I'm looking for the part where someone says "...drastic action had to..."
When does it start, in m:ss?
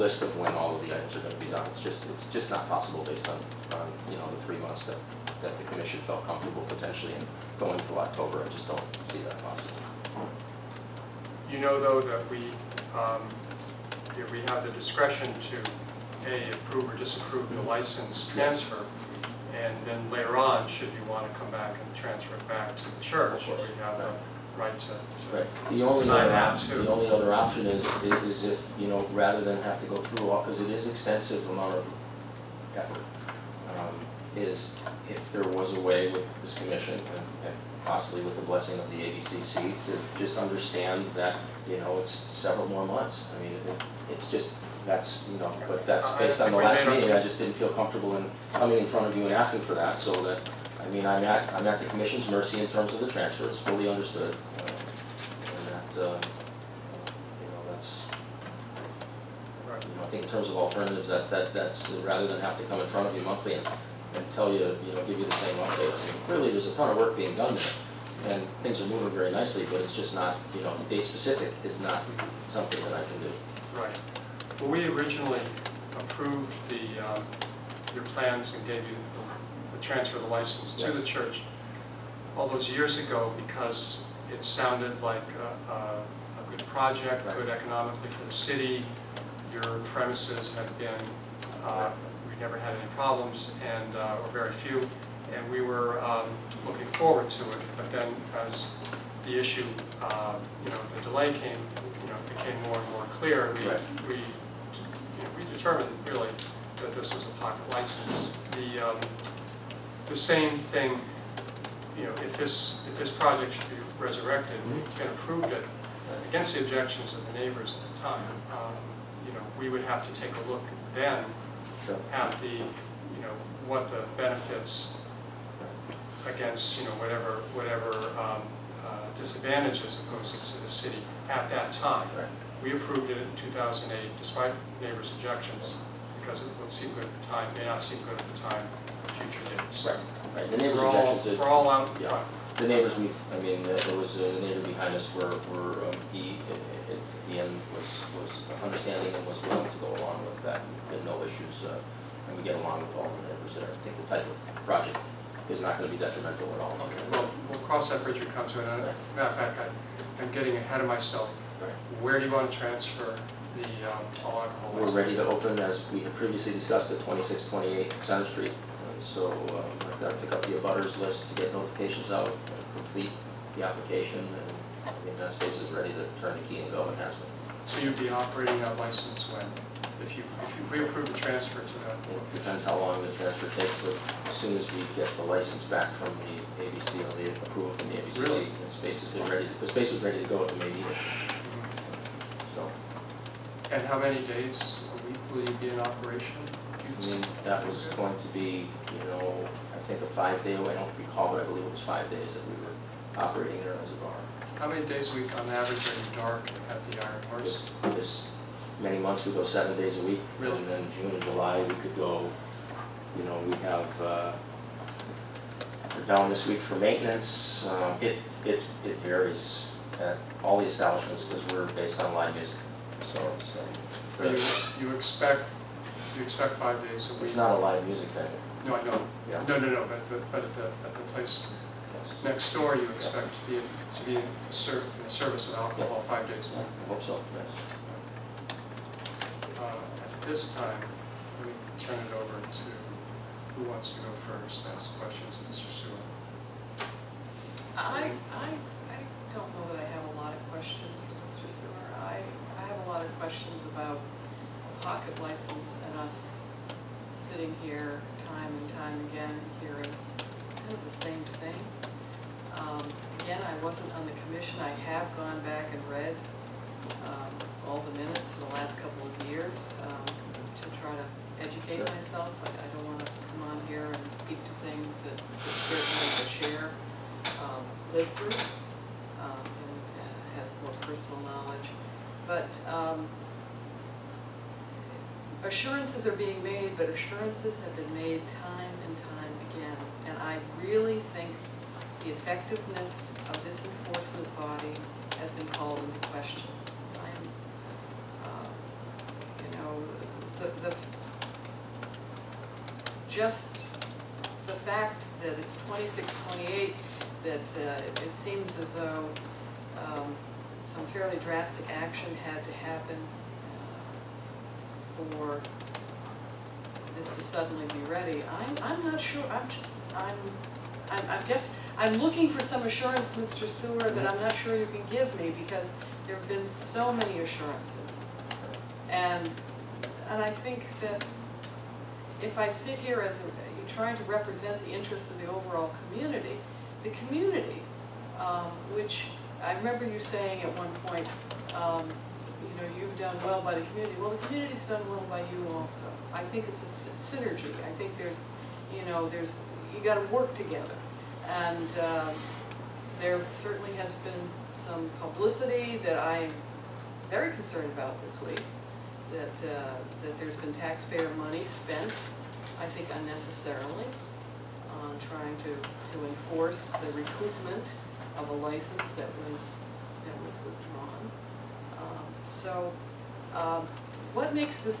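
5:11.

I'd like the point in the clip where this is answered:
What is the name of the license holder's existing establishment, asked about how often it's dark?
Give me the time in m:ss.
3:27.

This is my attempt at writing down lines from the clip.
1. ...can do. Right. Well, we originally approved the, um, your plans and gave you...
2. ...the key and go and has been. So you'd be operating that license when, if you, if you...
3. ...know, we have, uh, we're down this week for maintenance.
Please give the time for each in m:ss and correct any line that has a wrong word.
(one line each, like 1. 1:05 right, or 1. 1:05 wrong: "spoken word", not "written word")
1. 1:13 right
2. 2:56 right
3. 3:33 right.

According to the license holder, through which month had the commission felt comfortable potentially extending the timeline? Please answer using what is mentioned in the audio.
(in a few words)
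October.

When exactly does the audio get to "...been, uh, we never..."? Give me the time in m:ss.
1:30.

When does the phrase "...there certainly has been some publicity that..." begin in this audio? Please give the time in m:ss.
5:53.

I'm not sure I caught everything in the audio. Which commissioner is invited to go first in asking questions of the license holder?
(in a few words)
Mr. Sewell.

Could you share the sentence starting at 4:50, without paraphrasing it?
And I really think the effectiveness of this enforcement body has been called into question.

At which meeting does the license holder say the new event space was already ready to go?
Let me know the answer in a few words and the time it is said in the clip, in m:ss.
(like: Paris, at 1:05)
May meeting, at 3:10.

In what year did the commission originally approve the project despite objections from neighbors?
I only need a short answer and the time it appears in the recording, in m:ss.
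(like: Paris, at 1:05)
2008, at 2:13.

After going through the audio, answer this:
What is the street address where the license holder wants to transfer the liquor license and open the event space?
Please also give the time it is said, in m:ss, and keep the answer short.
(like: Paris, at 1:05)
2628 Center Street, at 2:47.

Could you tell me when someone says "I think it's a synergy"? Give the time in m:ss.
5:46.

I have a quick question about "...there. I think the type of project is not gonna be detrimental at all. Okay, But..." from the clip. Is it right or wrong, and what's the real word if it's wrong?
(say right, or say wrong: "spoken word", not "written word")
wrong: "Well", not "But".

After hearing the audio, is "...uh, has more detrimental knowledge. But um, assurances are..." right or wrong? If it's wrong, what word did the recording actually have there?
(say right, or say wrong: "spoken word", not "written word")
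wrong: "personal", not "detrimental".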